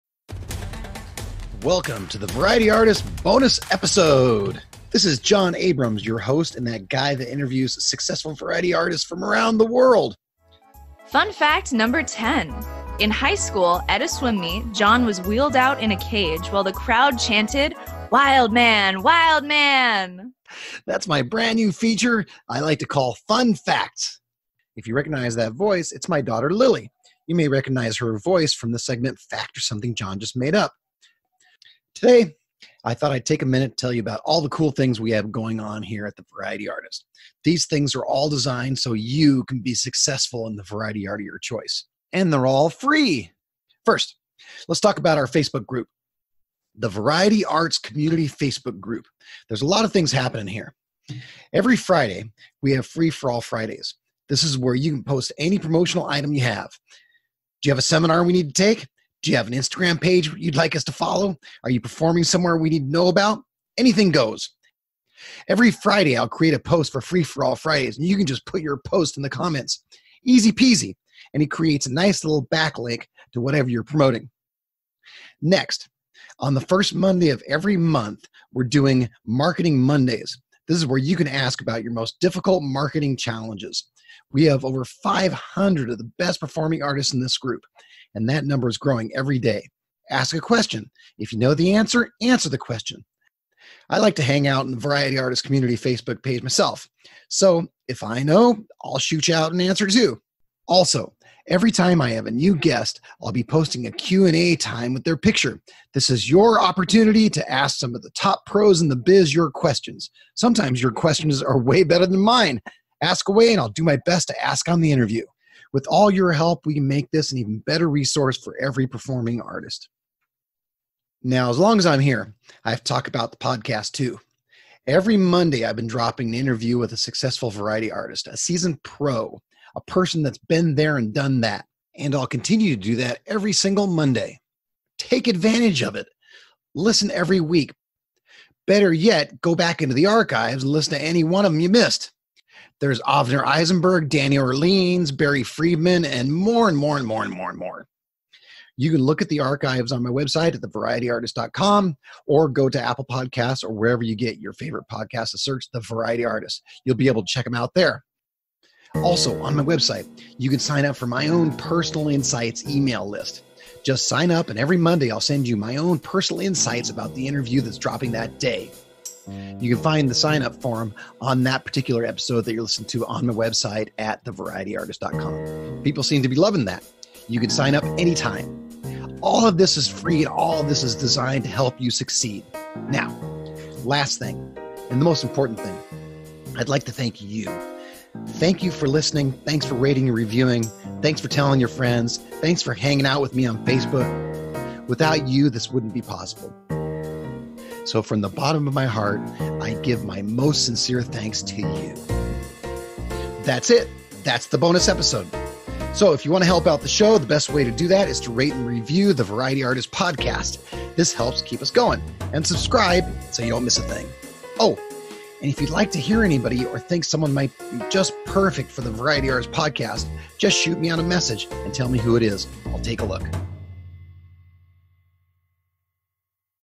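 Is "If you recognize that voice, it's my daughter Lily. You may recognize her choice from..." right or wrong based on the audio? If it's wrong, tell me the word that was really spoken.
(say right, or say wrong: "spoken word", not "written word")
wrong: "voice", not "choice".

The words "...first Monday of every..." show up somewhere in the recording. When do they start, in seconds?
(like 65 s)
76 s.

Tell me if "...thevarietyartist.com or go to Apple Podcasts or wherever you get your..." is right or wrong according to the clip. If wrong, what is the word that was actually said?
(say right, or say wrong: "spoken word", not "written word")
right.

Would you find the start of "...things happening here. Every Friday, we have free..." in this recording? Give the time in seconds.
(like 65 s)
49 s.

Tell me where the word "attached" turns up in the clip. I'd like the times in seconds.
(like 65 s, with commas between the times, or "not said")
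not said.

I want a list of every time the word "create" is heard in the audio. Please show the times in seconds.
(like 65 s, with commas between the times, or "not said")
66 s, 71 s.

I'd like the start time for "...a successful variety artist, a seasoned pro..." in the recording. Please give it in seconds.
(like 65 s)
126 s.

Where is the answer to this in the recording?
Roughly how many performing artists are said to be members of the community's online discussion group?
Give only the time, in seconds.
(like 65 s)
84 s.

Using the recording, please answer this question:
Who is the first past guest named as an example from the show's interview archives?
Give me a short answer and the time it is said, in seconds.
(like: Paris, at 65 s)
Avner Eisenberg, at 143 s.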